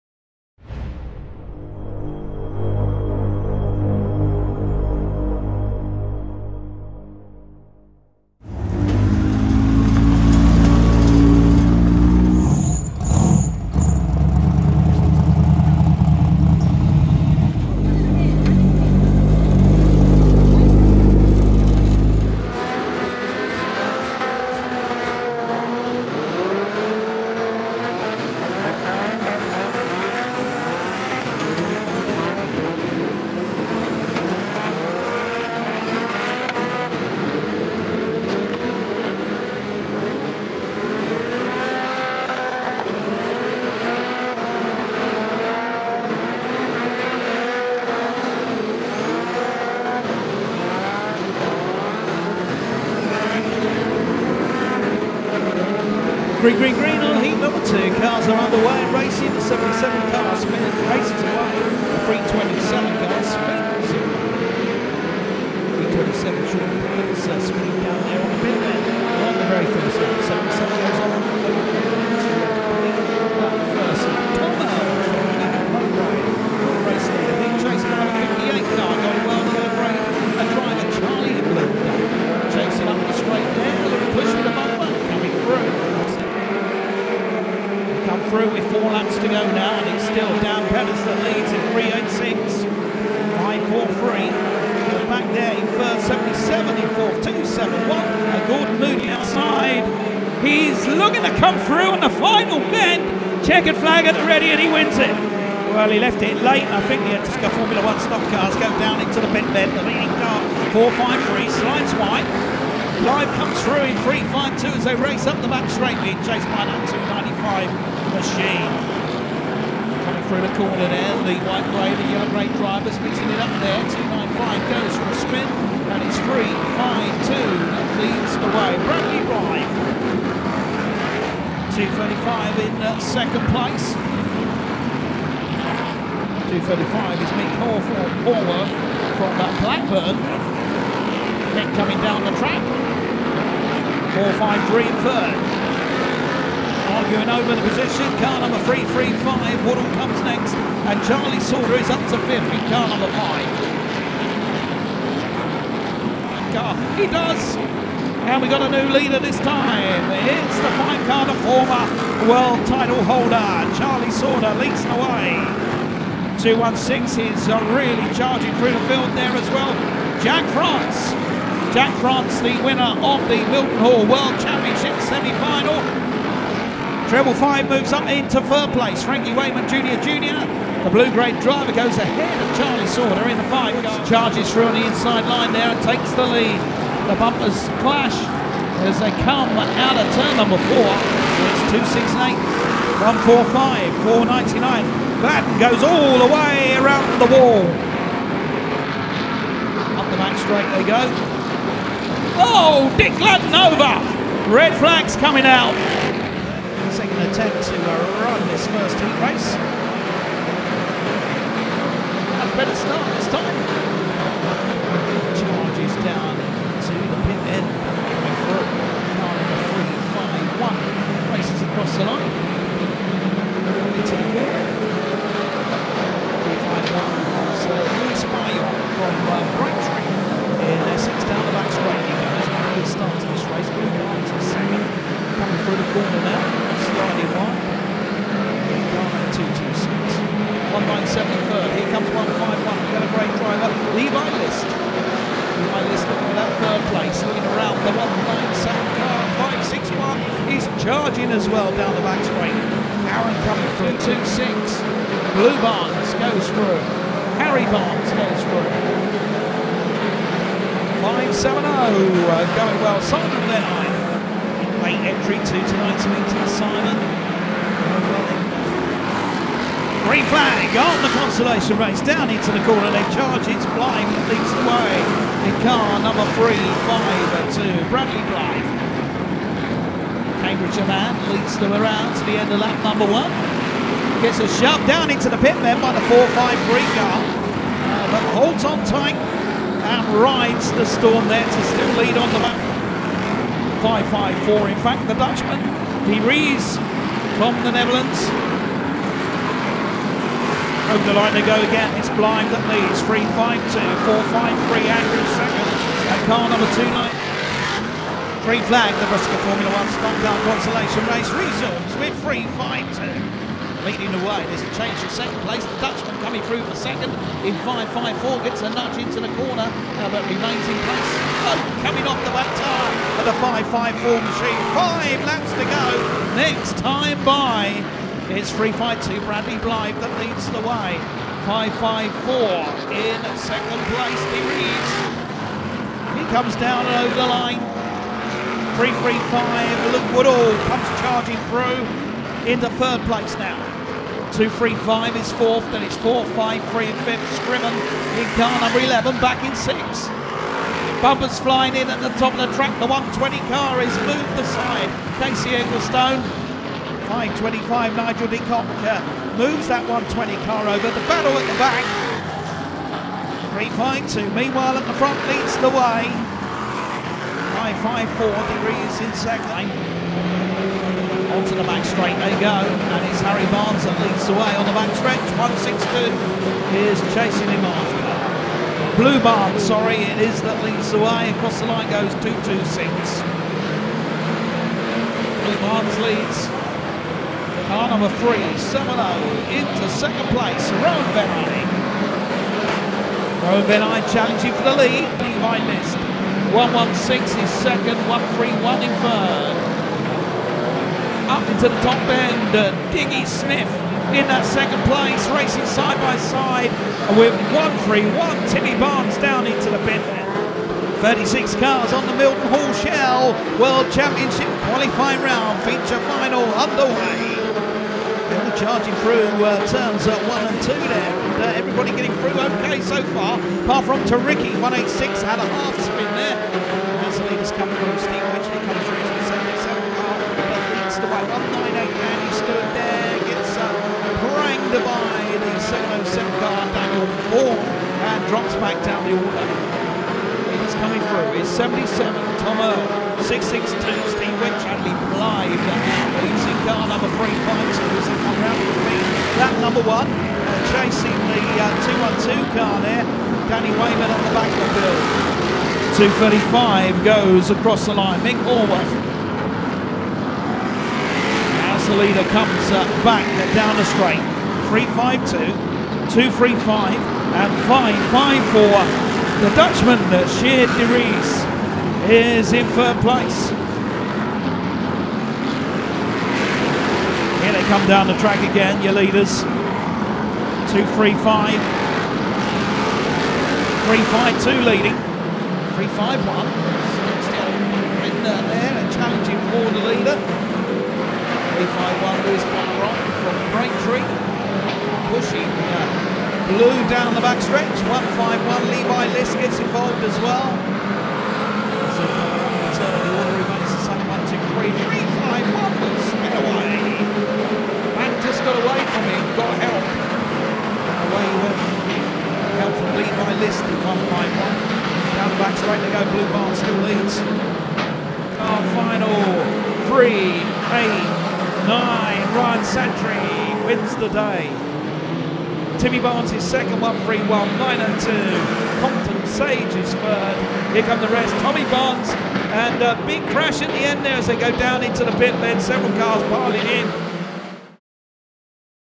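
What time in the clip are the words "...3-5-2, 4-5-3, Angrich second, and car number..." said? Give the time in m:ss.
5:03.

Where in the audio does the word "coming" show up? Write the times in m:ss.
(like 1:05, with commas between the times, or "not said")
1:58, 2:21, 3:25, 4:13, 5:16, 5:21, 7:20.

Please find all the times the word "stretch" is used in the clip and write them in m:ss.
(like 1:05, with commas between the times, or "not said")
6:14, 8:17.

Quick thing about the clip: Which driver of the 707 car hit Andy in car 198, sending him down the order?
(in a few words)
Daniel Vaughan.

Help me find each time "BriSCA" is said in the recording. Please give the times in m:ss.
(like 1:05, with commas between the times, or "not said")
1:47, 5:09.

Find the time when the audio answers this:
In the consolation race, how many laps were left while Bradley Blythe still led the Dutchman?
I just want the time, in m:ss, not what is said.
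5:24.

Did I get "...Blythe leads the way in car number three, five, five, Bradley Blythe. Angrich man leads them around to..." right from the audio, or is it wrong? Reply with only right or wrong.
wrong.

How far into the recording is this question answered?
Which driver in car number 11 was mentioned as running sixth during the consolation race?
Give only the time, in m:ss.
5:47.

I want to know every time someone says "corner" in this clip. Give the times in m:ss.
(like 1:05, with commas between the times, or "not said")
2:00, 4:32, 5:19.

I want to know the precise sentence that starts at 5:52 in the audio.
The 120 car is moved aside.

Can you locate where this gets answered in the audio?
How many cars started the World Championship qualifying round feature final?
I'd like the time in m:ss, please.
6:50.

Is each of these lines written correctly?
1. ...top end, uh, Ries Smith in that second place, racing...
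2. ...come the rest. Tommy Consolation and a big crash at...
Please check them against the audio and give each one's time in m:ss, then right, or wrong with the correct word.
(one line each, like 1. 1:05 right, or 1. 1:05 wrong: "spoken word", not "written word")
1. 6:41 wrong: "Diggy", not "Ries"
2. 8:50 wrong: "Barnes", not "Consolation".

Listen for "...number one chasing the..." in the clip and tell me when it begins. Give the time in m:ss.
7:29.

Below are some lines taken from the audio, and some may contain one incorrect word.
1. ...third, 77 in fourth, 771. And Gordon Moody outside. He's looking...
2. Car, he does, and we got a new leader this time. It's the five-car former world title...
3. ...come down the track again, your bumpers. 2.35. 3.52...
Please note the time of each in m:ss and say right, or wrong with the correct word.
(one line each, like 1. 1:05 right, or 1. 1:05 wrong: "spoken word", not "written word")
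1. 1:35 wrong: "271", not "771"
2. 2:36 right
3. 7:57 wrong: "leaders", not "bumpers".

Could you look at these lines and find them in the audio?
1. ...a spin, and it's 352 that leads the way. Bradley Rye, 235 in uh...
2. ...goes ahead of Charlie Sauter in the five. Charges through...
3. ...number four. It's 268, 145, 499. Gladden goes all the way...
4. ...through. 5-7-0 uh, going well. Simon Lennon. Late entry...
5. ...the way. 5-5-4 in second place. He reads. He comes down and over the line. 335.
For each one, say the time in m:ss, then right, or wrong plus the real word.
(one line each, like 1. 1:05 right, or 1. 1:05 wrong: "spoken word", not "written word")
1. 2:05 right
2. 3:01 right
3. 3:10 right
4. 4:18 right
5. 5:30 right.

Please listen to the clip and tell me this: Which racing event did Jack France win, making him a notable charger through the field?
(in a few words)
Mildenhall World Championship semi-final.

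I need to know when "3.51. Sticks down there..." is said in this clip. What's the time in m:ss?
8:05.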